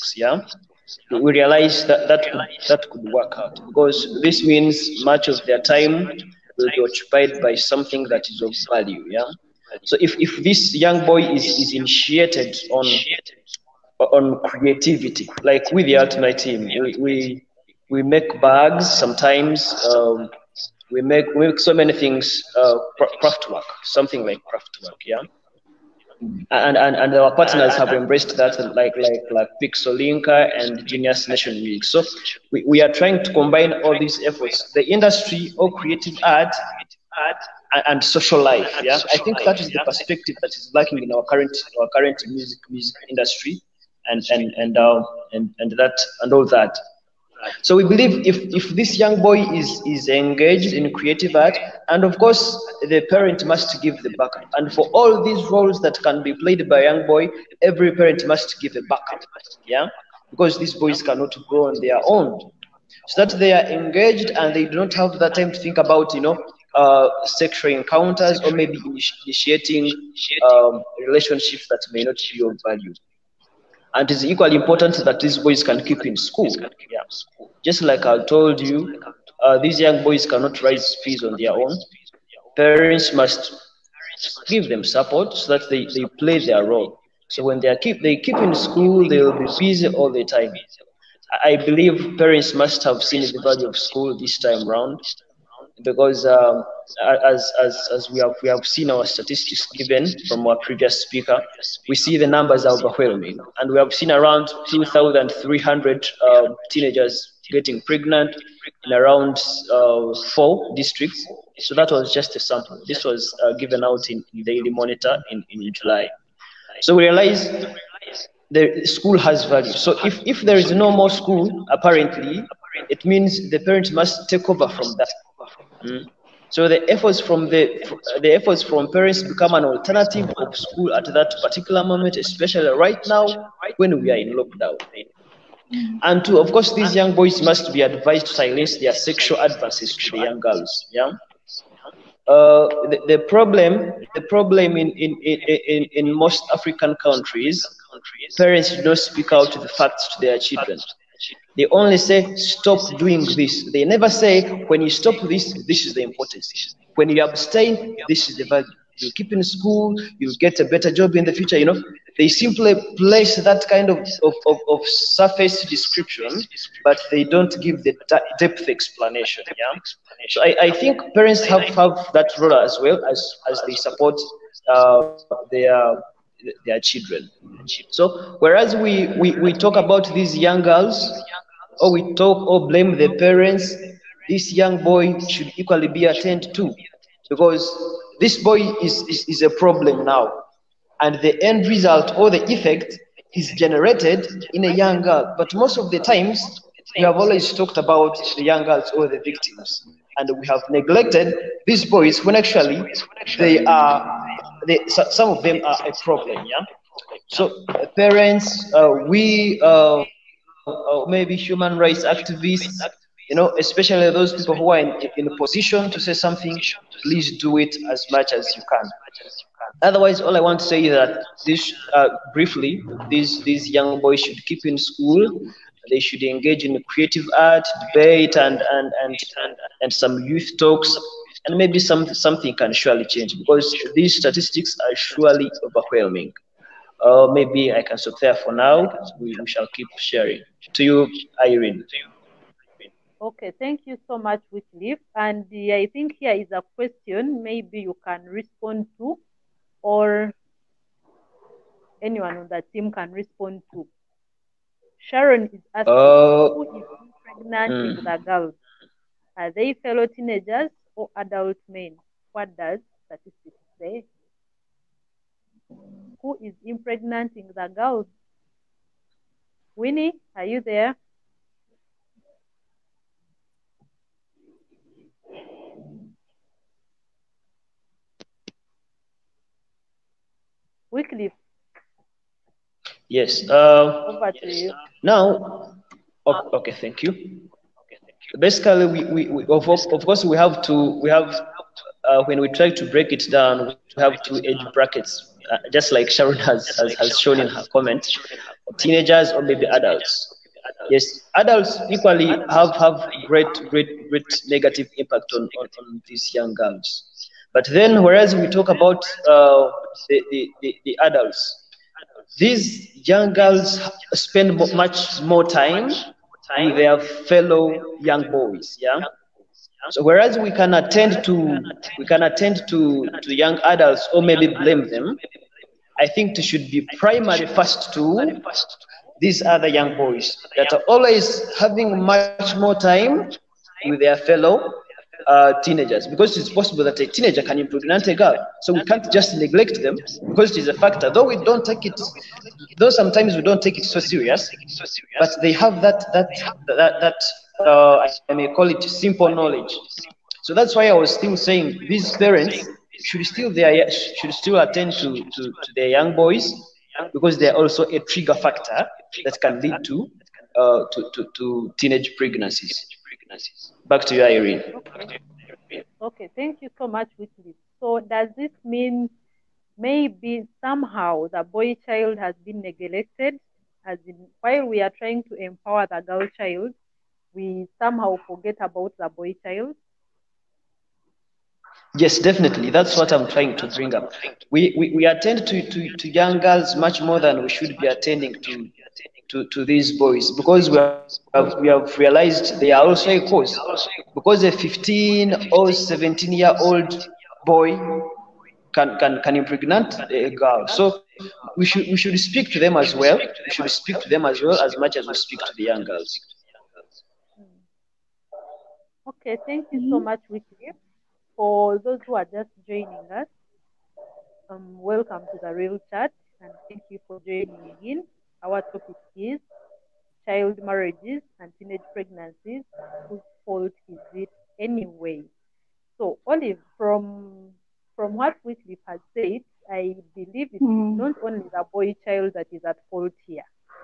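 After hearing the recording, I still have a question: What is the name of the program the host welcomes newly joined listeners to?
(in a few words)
Real Chat.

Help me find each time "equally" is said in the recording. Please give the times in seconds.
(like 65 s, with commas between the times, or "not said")
74 s, 185 s, 301 s.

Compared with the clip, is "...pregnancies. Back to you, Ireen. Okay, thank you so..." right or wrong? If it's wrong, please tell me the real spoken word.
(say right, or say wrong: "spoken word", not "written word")
right.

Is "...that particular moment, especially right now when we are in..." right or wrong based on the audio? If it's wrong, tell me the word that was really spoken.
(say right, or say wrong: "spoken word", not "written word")
right.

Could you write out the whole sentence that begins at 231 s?
And maybe some, something can surely change because these statistics are surely overwhelming.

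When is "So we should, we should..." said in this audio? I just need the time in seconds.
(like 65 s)
400 s.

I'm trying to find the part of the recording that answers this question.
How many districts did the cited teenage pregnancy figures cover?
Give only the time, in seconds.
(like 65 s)
110 s.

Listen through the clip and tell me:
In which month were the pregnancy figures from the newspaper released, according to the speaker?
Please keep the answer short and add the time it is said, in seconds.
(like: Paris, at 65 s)
July, at 115 s.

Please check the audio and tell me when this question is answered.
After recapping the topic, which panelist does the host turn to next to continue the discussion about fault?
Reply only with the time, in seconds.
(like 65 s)
426 s.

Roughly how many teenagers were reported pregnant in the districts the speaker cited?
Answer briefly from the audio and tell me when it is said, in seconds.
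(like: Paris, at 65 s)
2,300, at 104 s.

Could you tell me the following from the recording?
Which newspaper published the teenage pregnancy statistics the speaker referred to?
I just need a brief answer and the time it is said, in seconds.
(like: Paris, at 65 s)
Daily Monitor, at 114 s.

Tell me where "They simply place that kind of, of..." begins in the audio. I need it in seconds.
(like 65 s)
162 s.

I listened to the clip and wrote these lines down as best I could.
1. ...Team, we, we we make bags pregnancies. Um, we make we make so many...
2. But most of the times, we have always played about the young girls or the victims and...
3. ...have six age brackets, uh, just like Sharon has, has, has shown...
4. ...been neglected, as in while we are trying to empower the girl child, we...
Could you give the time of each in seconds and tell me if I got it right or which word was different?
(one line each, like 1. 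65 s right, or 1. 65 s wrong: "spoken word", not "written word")
1. 16 s wrong: "sometimes", not "pregnancies"
2. 195 s wrong: "talked", not "played"
3. 294 s wrong: "two", not "six"
4. 372 s right.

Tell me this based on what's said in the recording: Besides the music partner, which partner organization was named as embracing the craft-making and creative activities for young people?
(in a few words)
Pixelinka.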